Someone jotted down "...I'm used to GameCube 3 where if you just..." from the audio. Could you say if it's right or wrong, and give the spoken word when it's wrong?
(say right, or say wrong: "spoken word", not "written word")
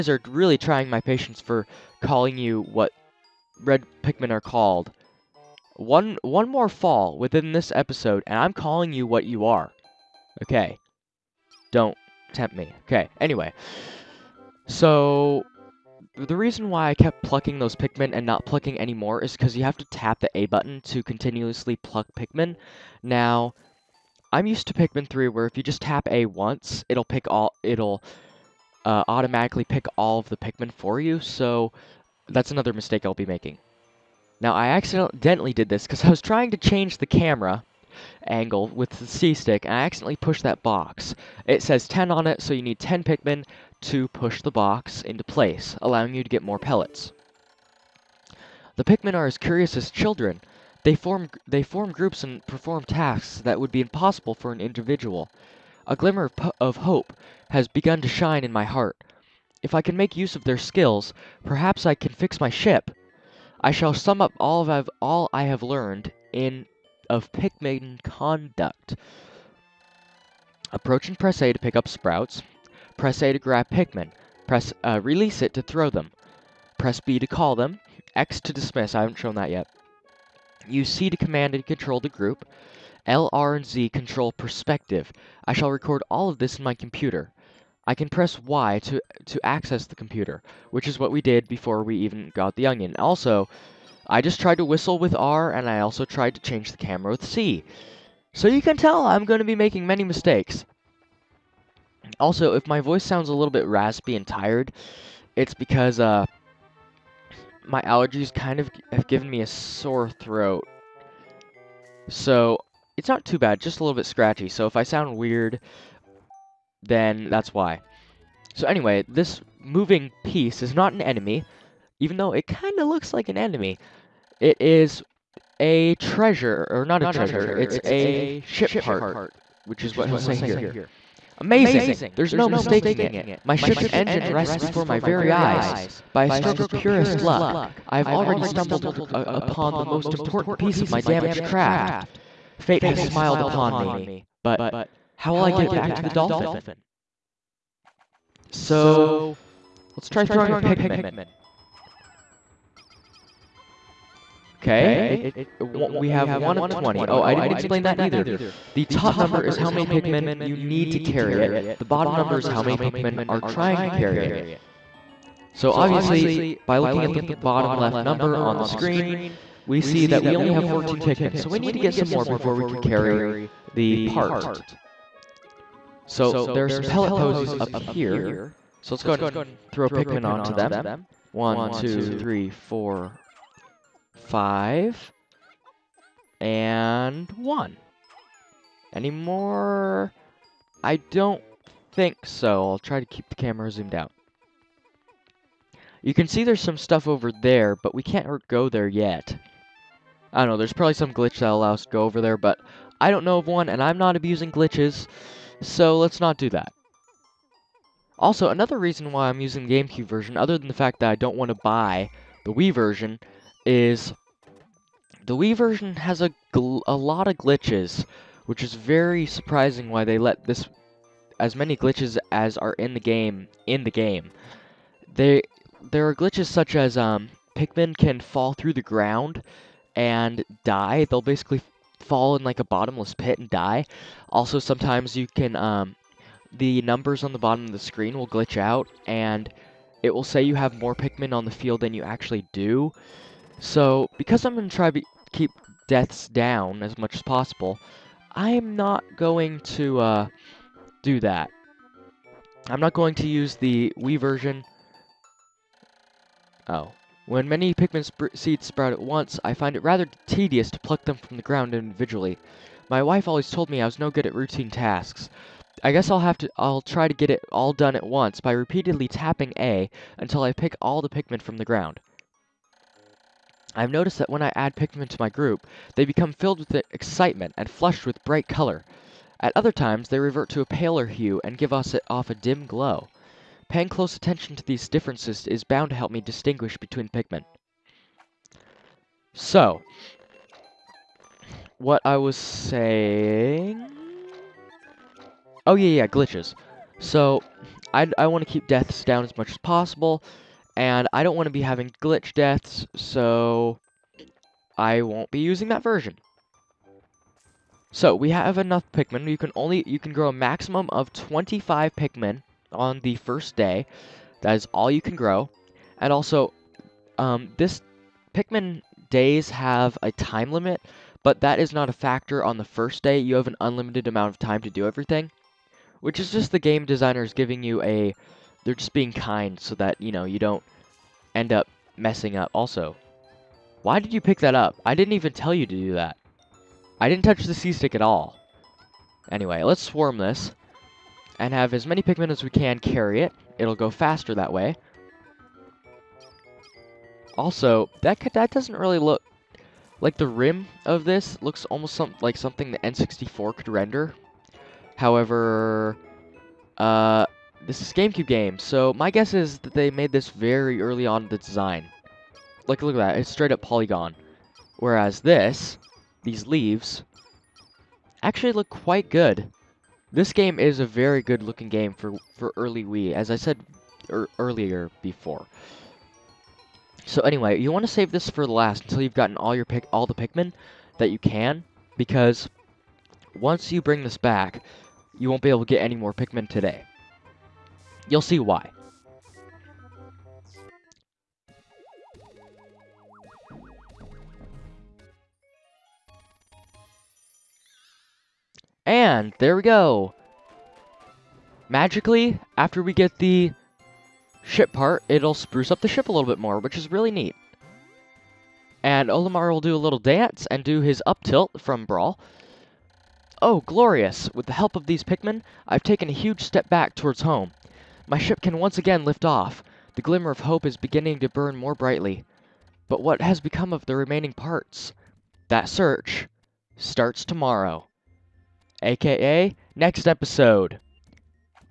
wrong: "Pikmin", not "GameCube".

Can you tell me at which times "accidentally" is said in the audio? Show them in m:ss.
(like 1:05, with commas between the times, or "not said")
0:34, 0:39.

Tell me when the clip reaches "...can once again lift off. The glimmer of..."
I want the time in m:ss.
6:58.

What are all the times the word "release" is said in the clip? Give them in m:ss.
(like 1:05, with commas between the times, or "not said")
1:15.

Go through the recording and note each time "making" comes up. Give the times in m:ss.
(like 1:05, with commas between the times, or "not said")
0:33, 1:39.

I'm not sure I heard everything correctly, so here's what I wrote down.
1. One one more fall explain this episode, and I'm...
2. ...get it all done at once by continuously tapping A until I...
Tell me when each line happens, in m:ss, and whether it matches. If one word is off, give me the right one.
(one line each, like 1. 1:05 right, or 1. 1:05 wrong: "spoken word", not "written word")
1. 0:05 wrong: "within", not "explain"
2. 4:27 wrong: "repeatedly", not "continuously".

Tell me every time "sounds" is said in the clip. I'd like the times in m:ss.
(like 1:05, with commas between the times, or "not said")
1:43, 1:54.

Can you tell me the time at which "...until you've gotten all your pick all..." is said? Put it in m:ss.
6:18.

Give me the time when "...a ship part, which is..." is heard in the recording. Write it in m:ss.
2:07.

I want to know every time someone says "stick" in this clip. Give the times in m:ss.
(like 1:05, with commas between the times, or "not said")
0:39, 5:37.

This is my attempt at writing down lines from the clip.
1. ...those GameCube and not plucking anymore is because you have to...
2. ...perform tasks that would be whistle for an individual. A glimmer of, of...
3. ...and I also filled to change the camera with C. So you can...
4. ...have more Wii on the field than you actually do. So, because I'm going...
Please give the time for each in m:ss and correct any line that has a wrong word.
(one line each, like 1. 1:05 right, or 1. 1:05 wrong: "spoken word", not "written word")
1. 0:17 wrong: "Pikmin", not "GameCube"
2. 0:52 wrong: "impossible", not "whistle"
3. 1:35 wrong: "tried", not "filled"
4. 4:00 wrong: "Pikmin", not "Wii".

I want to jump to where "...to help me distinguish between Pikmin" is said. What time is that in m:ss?
4:45.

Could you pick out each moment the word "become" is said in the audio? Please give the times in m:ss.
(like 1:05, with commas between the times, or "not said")
4:36, 7:03.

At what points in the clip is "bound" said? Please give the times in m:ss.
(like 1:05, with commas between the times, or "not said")
4:45.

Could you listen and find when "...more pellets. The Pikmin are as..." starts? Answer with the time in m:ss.
0:46.